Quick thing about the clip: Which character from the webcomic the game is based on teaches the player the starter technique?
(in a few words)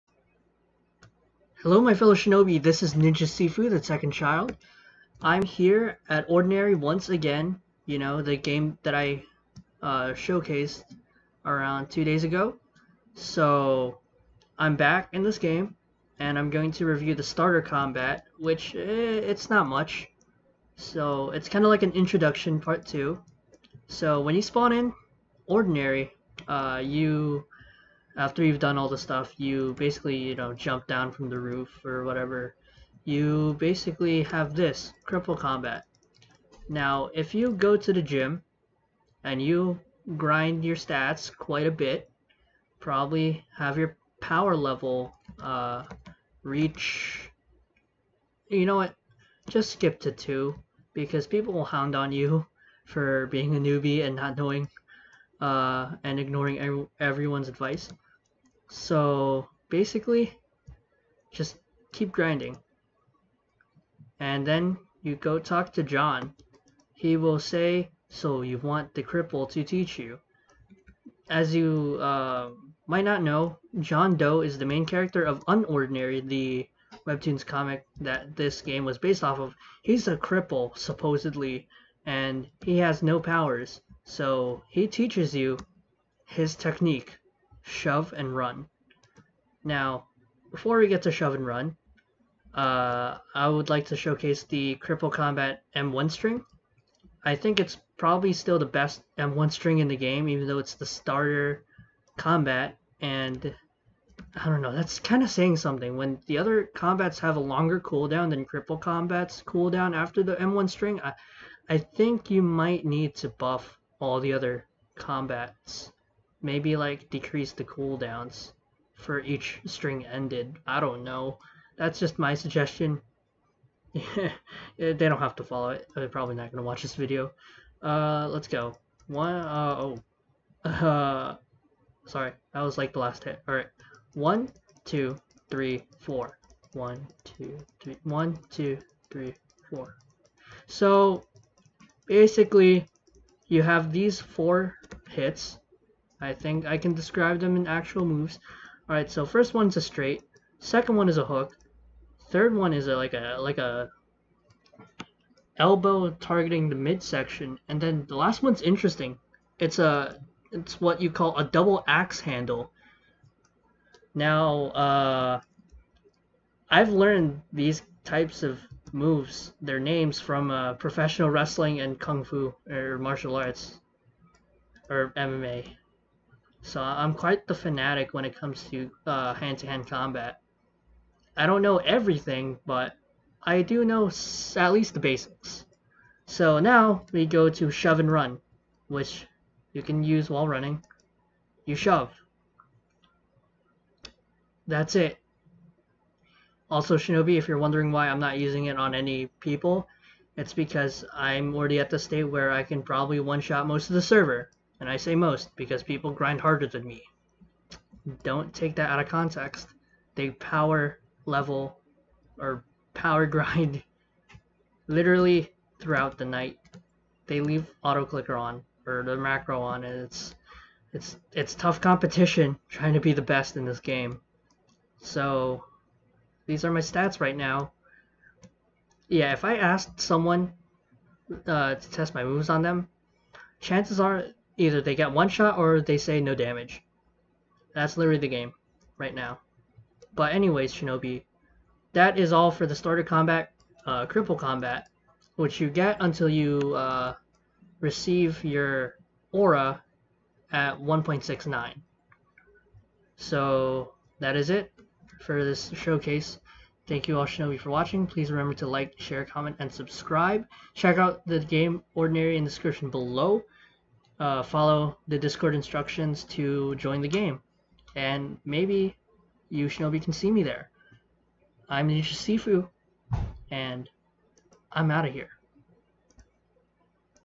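John Doe.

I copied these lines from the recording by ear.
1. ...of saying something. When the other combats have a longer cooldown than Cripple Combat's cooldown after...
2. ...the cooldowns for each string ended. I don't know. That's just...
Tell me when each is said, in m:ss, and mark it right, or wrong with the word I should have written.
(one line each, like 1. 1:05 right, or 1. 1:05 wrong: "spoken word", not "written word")
1. 1:45 right
2. 1:57 right.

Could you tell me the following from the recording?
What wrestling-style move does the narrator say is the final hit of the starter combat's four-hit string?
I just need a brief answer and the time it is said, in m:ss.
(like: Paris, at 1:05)
Double axe handle, at 2:41.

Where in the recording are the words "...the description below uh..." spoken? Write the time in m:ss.
4:22.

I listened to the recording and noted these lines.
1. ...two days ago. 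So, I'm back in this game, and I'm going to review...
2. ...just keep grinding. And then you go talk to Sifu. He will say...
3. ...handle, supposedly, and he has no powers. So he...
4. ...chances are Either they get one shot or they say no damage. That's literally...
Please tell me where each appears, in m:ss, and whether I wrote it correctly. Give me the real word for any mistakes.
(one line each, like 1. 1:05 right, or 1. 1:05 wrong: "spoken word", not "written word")
1. 0:11 right
2. 1:01 wrong: "John", not "Sifu"
3. 1:20 wrong: "cripple", not "handle"
4. 3:53 right.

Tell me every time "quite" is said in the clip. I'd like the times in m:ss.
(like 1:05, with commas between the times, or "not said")
0:41, 2:57.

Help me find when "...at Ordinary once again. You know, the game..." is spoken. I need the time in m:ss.
0:06.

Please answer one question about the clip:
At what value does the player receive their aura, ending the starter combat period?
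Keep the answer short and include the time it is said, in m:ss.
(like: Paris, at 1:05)
1.69, at 4:10.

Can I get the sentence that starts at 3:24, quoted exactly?
And I say most because people grind harder than me.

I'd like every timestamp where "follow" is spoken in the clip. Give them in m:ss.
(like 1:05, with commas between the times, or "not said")
2:05, 4:24.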